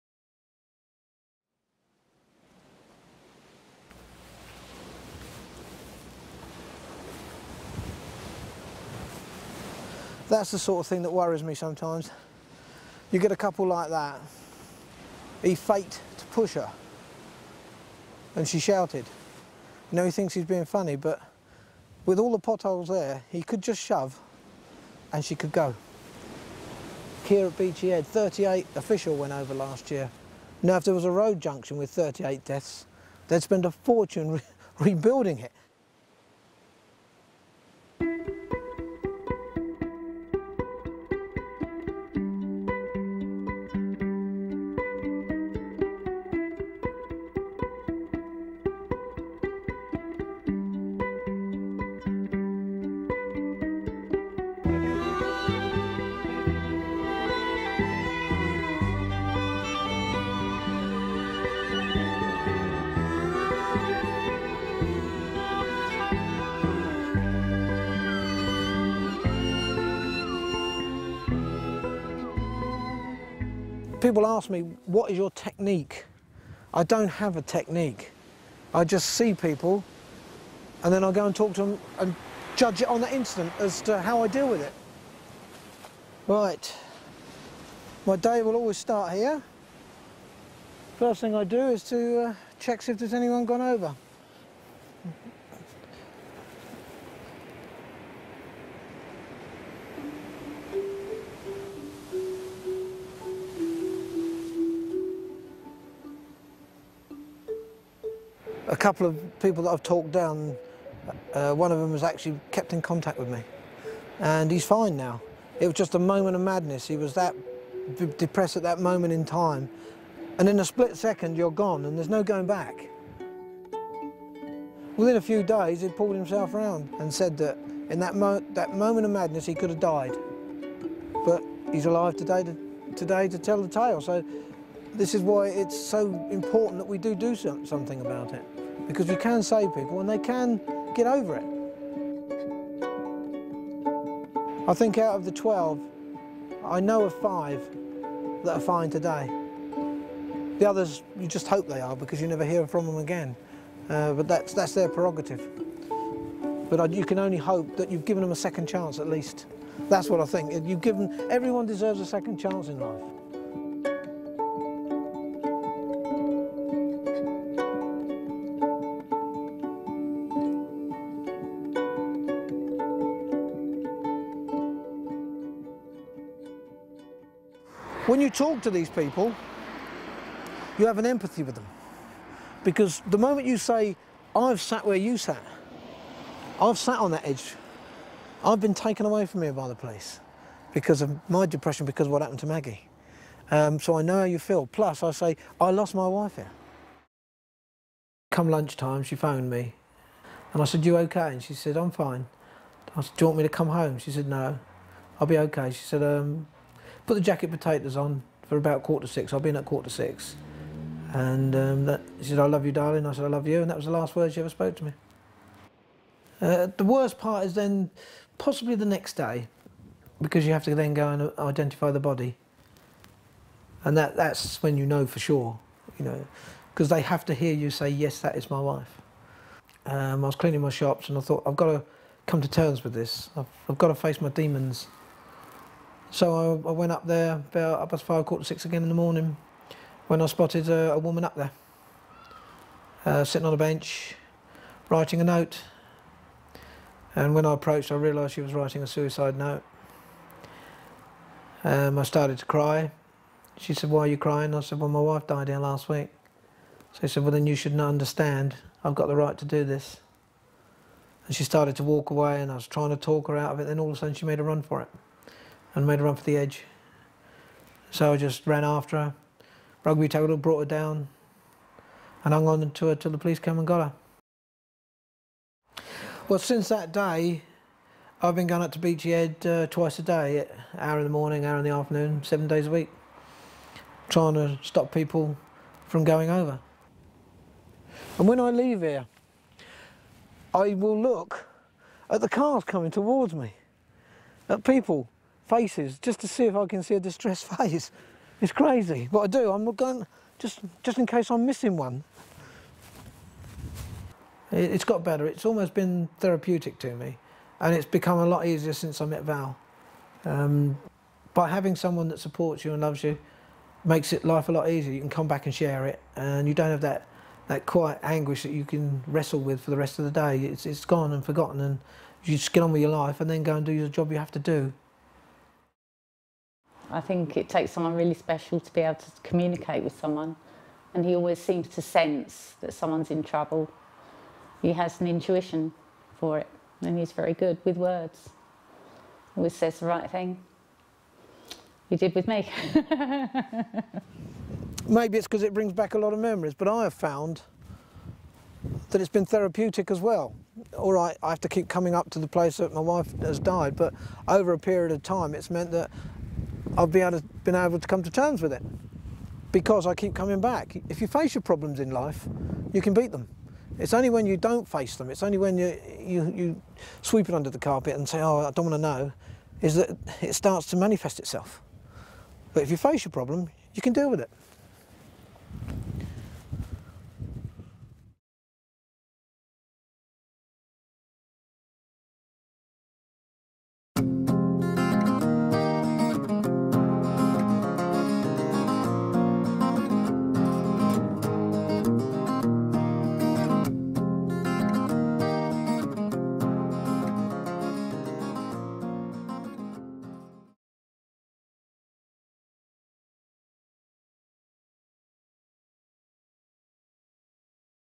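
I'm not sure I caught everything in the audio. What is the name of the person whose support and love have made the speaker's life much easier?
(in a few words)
Val.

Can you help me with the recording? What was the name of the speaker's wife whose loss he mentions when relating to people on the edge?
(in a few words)
Maggie.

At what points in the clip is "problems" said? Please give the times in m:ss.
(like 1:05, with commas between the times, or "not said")
6:01, 6:13.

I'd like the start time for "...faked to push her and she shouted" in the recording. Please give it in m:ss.
0:15.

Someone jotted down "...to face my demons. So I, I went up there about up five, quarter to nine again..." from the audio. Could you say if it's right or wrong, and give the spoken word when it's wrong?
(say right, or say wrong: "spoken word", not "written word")
wrong: "six", not "nine".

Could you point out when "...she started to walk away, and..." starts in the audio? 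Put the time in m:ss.
4:21.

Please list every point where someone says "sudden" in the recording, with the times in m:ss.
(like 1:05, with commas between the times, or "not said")
4:23.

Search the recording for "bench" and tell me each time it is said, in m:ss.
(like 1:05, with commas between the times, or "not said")
4:03.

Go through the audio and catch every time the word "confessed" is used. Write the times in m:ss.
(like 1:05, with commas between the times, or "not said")
not said.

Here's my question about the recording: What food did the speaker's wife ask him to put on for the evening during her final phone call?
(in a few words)
Jacket potatoes.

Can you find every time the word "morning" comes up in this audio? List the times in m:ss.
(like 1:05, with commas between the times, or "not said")
3:58, 4:41.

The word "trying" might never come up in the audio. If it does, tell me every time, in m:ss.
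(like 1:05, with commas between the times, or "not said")
4:22, 4:44.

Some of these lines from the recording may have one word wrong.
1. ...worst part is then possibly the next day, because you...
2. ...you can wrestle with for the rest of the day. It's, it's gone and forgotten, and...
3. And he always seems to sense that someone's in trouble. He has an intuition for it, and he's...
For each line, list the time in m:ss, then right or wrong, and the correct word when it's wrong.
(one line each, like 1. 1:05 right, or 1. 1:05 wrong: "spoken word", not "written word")
1. 3:36 right
2. 5:18 right
3. 5:30 right.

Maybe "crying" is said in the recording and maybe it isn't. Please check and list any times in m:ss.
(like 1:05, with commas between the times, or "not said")
4:14.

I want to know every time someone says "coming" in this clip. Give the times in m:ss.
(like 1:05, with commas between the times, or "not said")
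4:52, 5:51, 6:00.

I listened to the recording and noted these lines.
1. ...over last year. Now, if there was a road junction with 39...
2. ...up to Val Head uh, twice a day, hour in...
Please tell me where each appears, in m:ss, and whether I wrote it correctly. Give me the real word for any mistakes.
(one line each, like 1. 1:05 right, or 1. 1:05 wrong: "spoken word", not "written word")
1. 0:29 wrong: "38", not "39"
2. 4:38 wrong: "Beachy", not "Val".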